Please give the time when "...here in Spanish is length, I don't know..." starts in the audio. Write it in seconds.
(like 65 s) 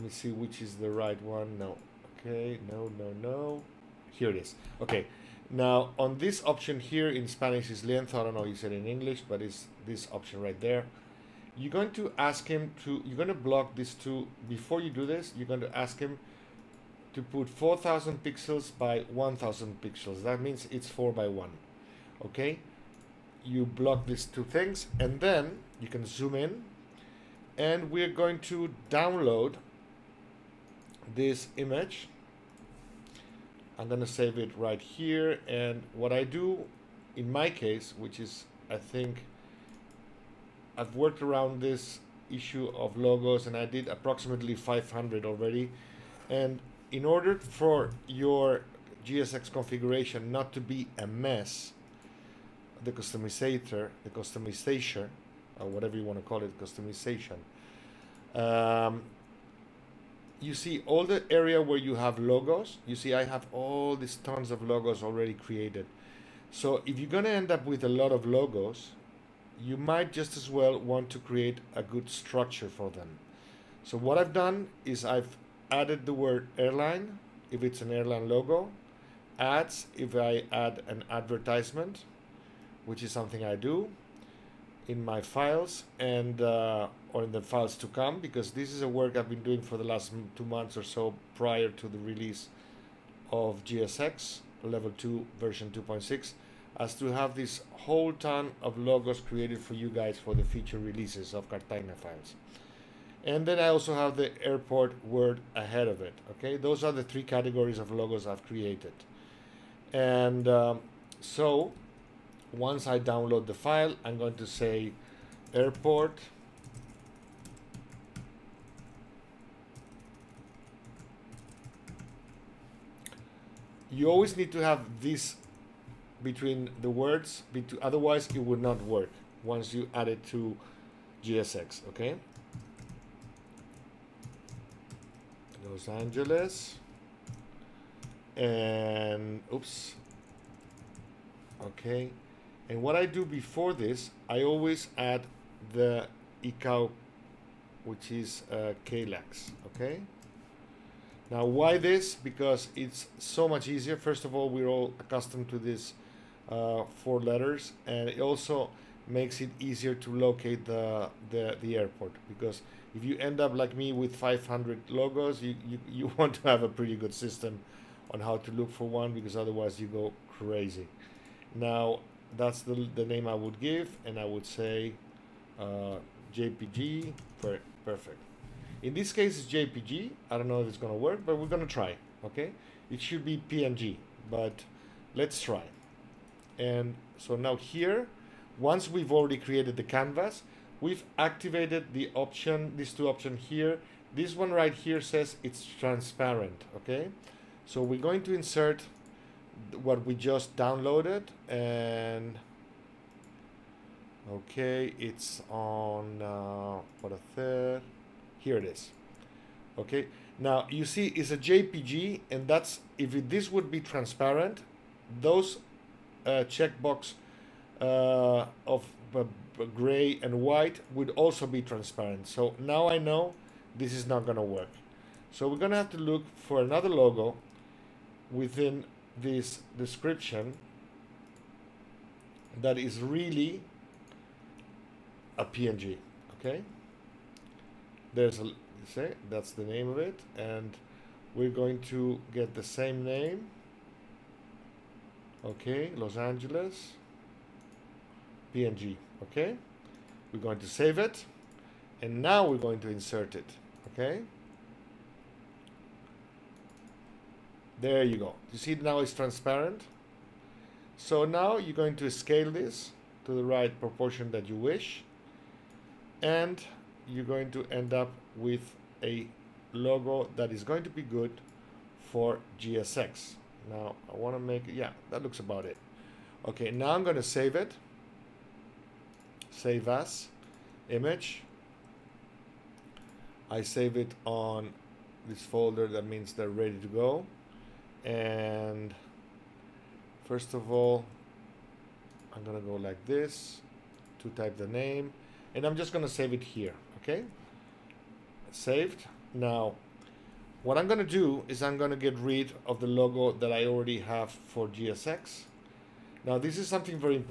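6 s.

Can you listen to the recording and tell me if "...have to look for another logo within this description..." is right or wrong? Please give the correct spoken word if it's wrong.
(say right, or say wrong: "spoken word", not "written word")
right.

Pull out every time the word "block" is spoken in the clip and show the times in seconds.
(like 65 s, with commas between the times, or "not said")
13 s, 23 s.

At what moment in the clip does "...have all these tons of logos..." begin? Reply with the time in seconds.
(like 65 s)
63 s.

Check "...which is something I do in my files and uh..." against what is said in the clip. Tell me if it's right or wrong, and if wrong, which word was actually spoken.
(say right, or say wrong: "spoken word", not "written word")
right.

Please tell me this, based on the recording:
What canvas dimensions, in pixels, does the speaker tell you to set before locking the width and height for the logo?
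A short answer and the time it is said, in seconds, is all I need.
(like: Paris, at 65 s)
4000 by 1000 pixels, at 17 s.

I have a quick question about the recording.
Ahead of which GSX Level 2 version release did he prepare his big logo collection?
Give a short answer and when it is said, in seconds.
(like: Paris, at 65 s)
2.6, at 95 s.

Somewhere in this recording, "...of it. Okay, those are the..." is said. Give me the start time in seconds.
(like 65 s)
105 s.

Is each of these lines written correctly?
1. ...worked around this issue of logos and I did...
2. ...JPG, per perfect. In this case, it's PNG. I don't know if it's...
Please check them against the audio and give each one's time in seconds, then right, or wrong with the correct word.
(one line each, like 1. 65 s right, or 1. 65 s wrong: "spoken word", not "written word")
1. 40 s right
2. 176 s wrong: "JPG", not "PNG".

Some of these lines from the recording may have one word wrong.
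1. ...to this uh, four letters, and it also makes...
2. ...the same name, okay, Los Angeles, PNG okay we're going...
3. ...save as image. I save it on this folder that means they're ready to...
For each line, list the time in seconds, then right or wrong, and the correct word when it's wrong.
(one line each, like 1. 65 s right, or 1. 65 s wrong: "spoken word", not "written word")
1. 155 s right
2. 242 s right
3. 279 s right.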